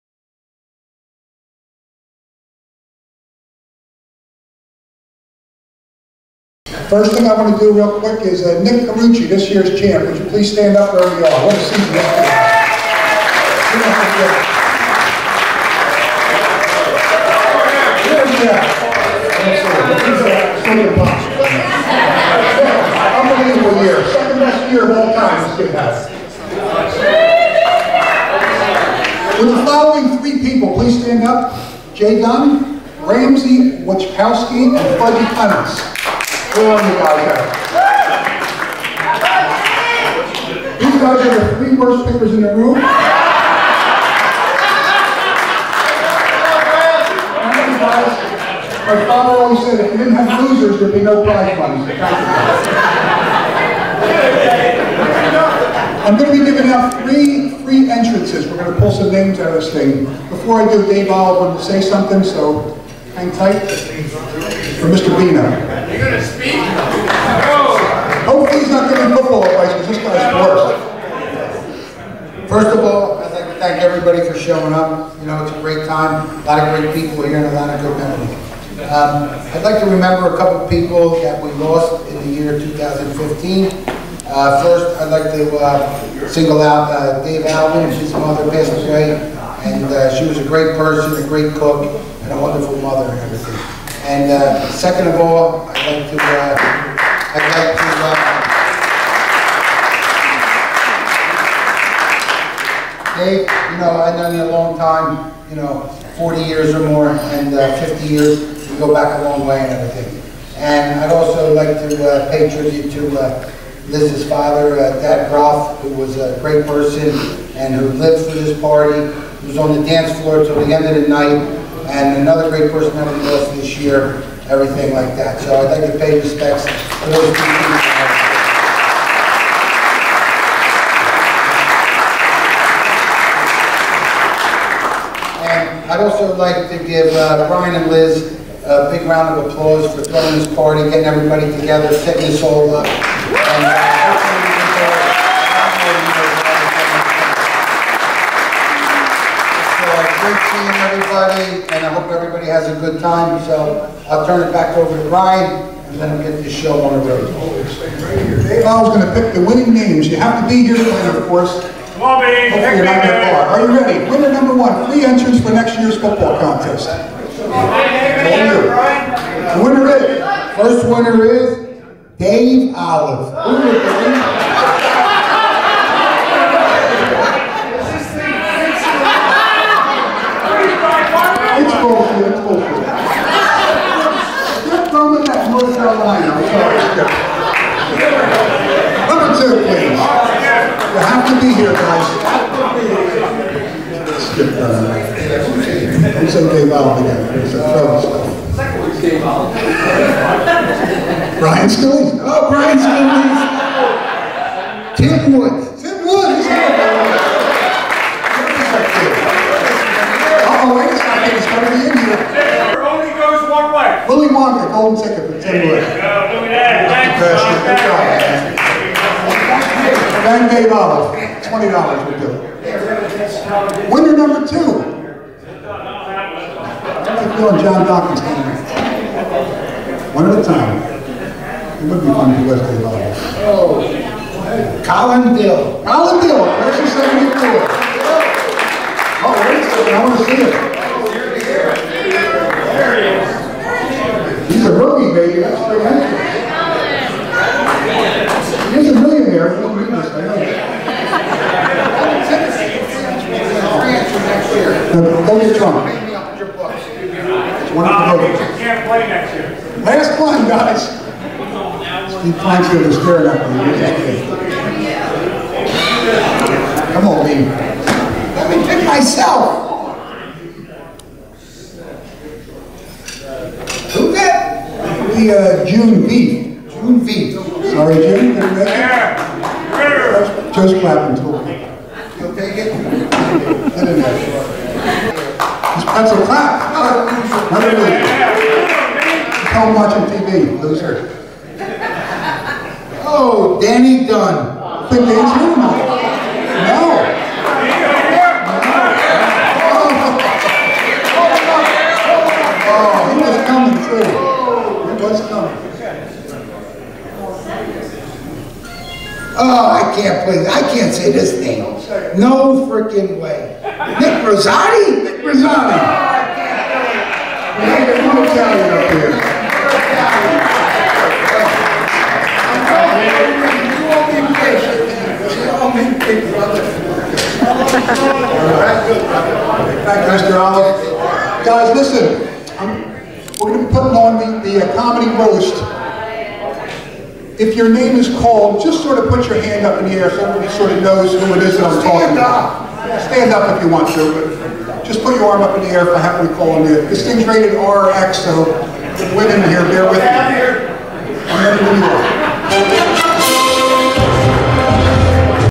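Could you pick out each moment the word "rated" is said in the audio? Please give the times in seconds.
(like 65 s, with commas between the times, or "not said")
347 s.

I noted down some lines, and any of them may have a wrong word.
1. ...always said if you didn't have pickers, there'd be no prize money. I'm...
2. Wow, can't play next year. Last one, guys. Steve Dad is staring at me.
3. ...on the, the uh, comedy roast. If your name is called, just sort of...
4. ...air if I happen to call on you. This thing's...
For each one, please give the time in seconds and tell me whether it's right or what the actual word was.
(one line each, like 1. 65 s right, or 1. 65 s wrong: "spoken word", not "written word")
1. 49 s wrong: "losers", not "pickers"
2. 257 s wrong: "Plansfield", not "Dad"
3. 333 s right
4. 345 s right.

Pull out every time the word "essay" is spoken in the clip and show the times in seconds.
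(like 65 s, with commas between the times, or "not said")
not said.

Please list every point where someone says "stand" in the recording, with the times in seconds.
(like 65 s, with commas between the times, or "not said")
10 s, 31 s, 343 s.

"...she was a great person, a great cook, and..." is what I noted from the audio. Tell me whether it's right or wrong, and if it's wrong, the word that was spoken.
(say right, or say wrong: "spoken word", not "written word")
right.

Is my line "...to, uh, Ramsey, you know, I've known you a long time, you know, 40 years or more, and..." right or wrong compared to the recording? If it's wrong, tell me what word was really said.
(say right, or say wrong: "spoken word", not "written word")
wrong: "Dave", not "Ramsey".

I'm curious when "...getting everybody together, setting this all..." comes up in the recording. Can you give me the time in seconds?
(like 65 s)
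140 s.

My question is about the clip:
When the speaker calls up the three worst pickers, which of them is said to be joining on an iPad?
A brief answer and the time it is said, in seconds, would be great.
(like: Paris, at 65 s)
Fudgy Clements, at 34 s.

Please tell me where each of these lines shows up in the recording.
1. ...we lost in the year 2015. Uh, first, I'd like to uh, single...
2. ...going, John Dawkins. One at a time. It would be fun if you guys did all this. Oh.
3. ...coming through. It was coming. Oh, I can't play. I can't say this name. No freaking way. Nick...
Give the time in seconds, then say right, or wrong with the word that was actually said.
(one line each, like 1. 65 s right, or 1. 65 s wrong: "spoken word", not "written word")
1. 81 s right
2. 227 s right
3. 303 s right.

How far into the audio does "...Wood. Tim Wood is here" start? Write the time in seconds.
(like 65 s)
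205 s.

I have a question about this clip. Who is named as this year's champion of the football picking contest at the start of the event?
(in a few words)
Nick Carucci.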